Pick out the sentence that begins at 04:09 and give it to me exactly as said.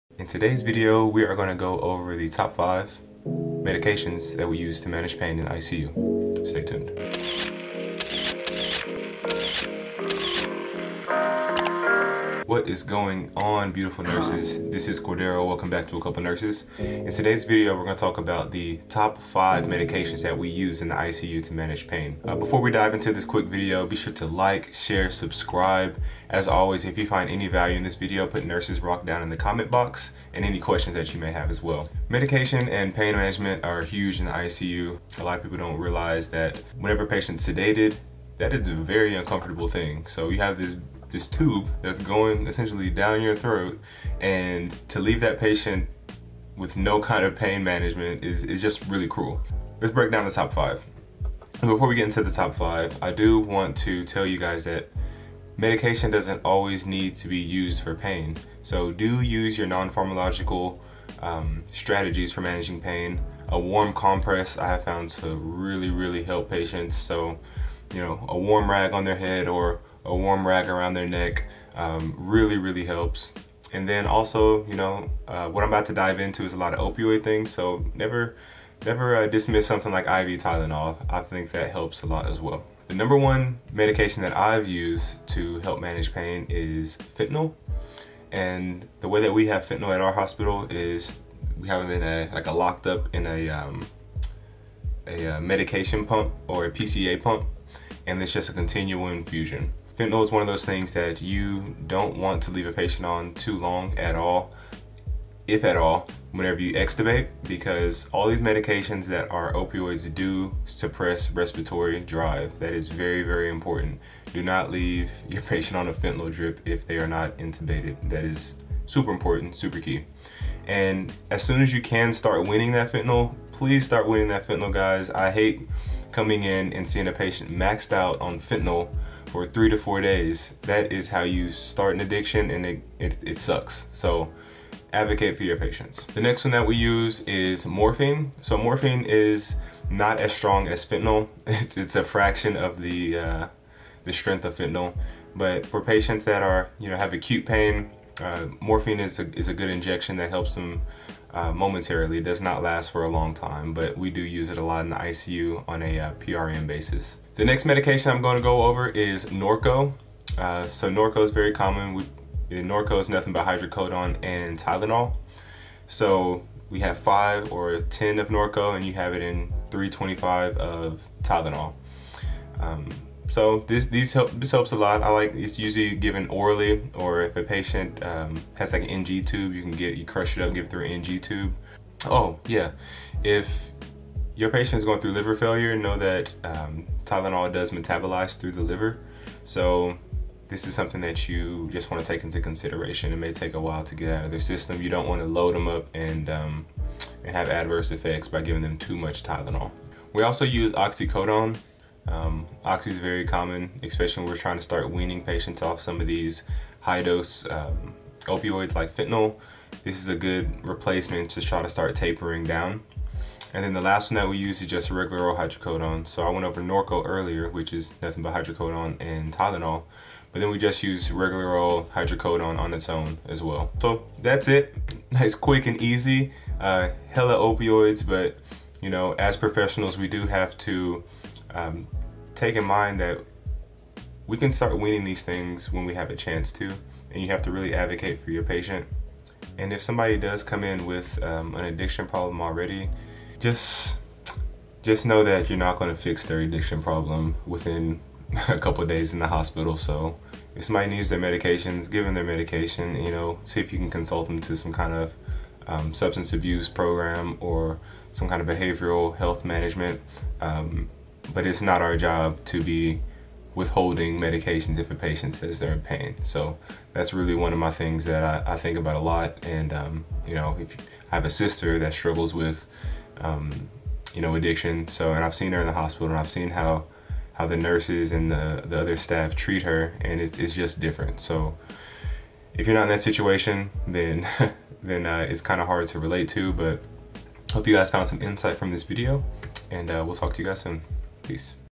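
So if somebody needs their medications, give them their medication.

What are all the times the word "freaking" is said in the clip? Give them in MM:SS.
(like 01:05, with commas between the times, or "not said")
not said.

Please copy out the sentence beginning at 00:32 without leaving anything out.
Medication and pain management are huge in the ICU.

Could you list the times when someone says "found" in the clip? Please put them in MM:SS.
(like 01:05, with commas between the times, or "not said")
01:04, 04:47.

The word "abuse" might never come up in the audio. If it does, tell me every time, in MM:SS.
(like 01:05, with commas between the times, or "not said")
04:16.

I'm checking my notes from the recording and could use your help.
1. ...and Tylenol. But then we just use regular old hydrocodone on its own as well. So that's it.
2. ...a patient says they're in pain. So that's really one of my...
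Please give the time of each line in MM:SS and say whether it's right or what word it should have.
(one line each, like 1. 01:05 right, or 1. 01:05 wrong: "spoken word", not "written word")
1. 03:38 right
2. 04:24 right.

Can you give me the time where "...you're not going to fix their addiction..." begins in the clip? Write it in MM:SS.
04:05.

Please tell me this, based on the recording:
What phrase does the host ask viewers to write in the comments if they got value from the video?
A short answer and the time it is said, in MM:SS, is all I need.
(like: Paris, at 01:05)
Nurses Rock, at 00:28.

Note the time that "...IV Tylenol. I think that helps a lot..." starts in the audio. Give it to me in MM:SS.
01:20.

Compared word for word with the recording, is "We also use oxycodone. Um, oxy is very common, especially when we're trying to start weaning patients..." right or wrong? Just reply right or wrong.
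right.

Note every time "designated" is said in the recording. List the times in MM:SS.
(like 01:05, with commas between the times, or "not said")
not said.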